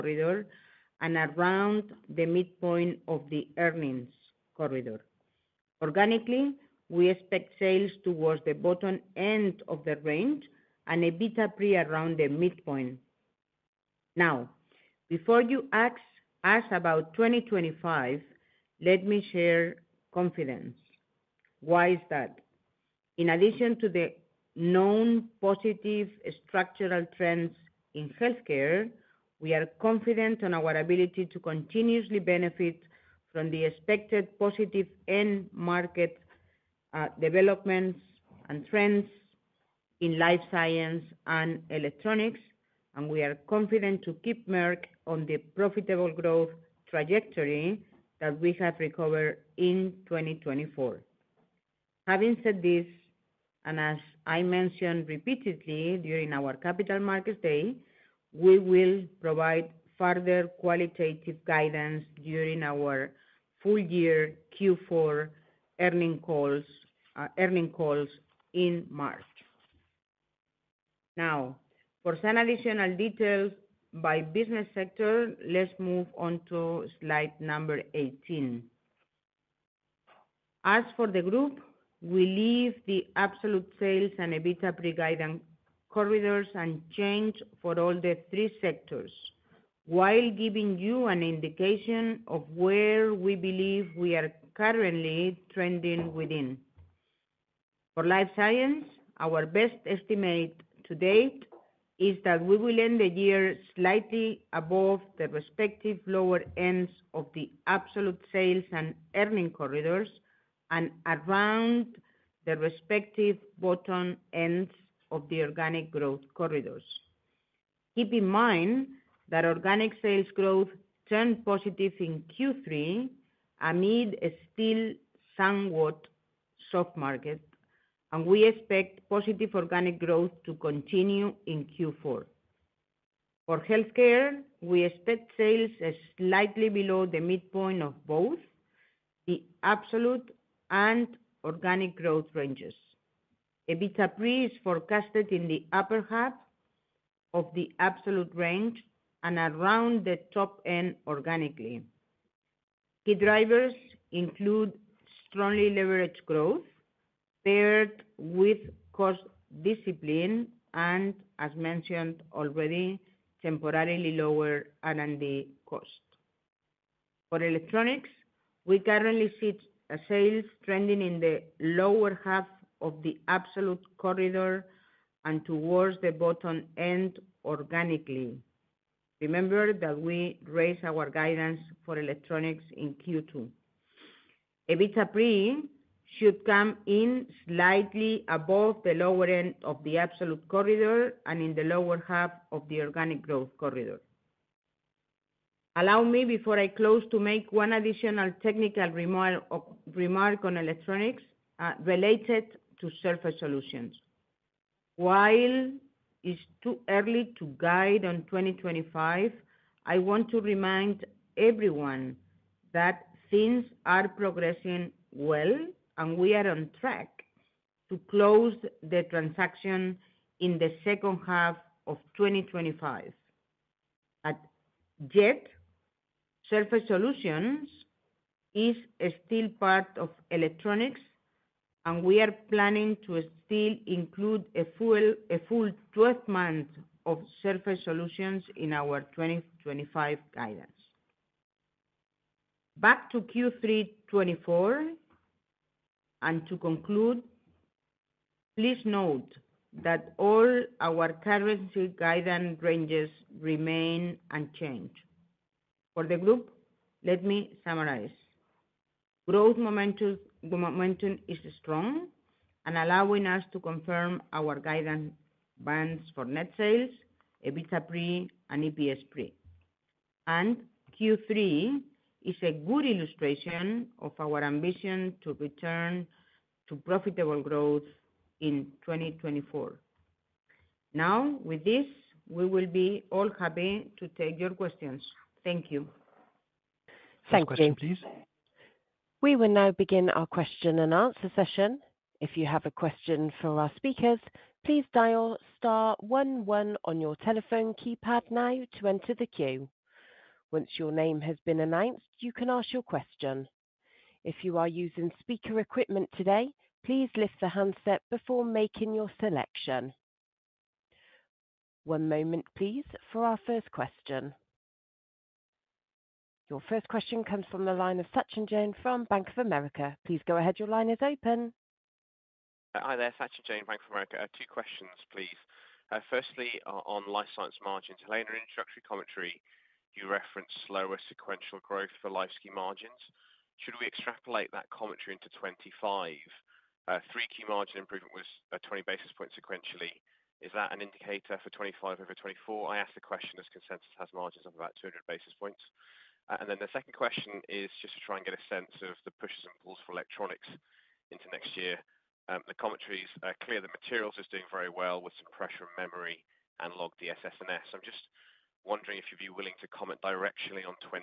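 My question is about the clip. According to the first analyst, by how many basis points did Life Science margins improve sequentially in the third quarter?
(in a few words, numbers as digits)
20.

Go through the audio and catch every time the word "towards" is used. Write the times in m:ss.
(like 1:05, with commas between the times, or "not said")
0:08, 2:55.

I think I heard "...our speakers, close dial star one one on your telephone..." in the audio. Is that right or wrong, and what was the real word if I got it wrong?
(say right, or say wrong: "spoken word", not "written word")
wrong: "please", not "close".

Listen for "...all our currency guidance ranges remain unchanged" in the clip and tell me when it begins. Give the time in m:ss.
4:10.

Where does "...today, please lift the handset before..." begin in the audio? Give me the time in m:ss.
5:06.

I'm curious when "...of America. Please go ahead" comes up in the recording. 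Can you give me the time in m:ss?
5:19.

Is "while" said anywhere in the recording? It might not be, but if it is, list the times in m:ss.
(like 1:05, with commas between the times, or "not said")
1:29, 3:24.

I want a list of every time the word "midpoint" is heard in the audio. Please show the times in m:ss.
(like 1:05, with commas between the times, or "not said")
0:02, 0:12, 2:17.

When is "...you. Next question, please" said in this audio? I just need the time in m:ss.
4:47.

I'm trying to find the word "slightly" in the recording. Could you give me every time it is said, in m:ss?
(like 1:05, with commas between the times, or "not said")
1:43, 2:16, 3:07.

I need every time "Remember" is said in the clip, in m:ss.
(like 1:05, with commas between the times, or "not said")
2:59.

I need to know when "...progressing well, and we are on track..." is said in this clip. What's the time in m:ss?
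3:34.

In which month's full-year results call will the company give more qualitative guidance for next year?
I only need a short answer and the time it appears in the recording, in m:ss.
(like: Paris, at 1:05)
March, at 1:08.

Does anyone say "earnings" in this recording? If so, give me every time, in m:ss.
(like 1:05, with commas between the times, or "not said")
0:03, 1:05, 1:49.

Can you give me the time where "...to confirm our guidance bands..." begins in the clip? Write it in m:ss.
4:23.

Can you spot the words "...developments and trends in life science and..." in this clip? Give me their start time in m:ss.
0:37.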